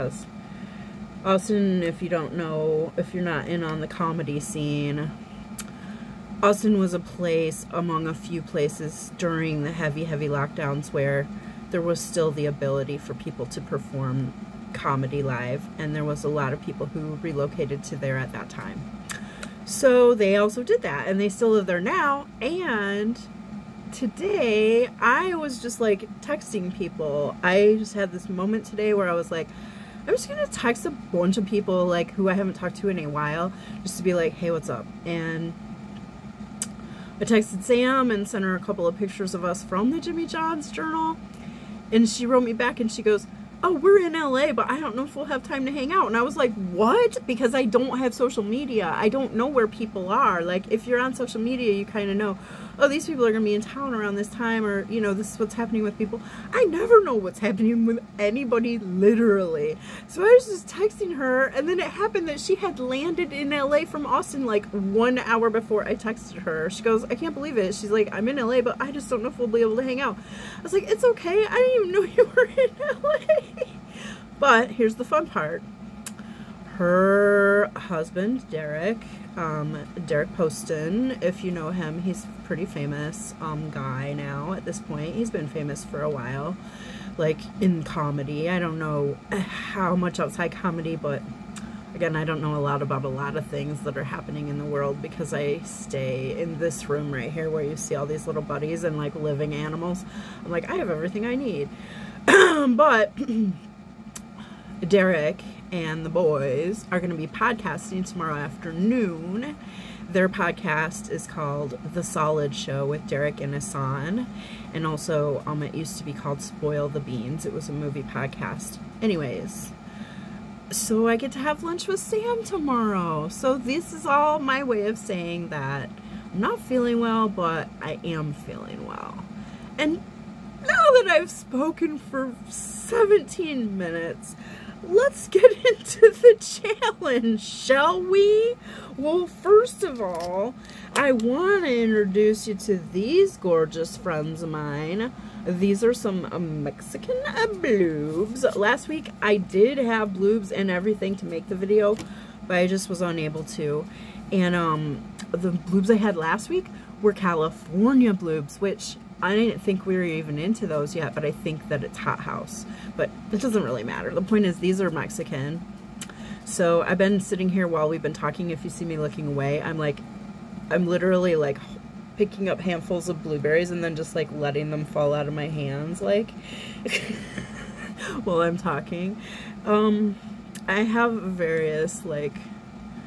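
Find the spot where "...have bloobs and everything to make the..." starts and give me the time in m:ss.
2:29.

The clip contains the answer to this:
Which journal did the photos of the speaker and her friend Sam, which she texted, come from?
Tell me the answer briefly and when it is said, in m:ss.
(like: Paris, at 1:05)
Jimmy John's journal, at 0:39.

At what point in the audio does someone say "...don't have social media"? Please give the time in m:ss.
0:47.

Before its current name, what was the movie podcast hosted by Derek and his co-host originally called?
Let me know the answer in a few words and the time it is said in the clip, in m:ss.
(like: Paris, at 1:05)
Spoil the Beans, at 1:56.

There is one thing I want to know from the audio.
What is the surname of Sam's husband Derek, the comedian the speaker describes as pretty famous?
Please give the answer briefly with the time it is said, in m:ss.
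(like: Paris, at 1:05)
Poston, at 1:20.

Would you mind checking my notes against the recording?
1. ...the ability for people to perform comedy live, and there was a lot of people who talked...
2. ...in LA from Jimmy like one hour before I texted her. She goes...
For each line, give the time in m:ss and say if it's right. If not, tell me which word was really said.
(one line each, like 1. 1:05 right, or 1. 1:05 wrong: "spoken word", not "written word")
1. 0:12 wrong: "relocated", not "talked"
2. 1:03 wrong: "Austin", not "Jimmy".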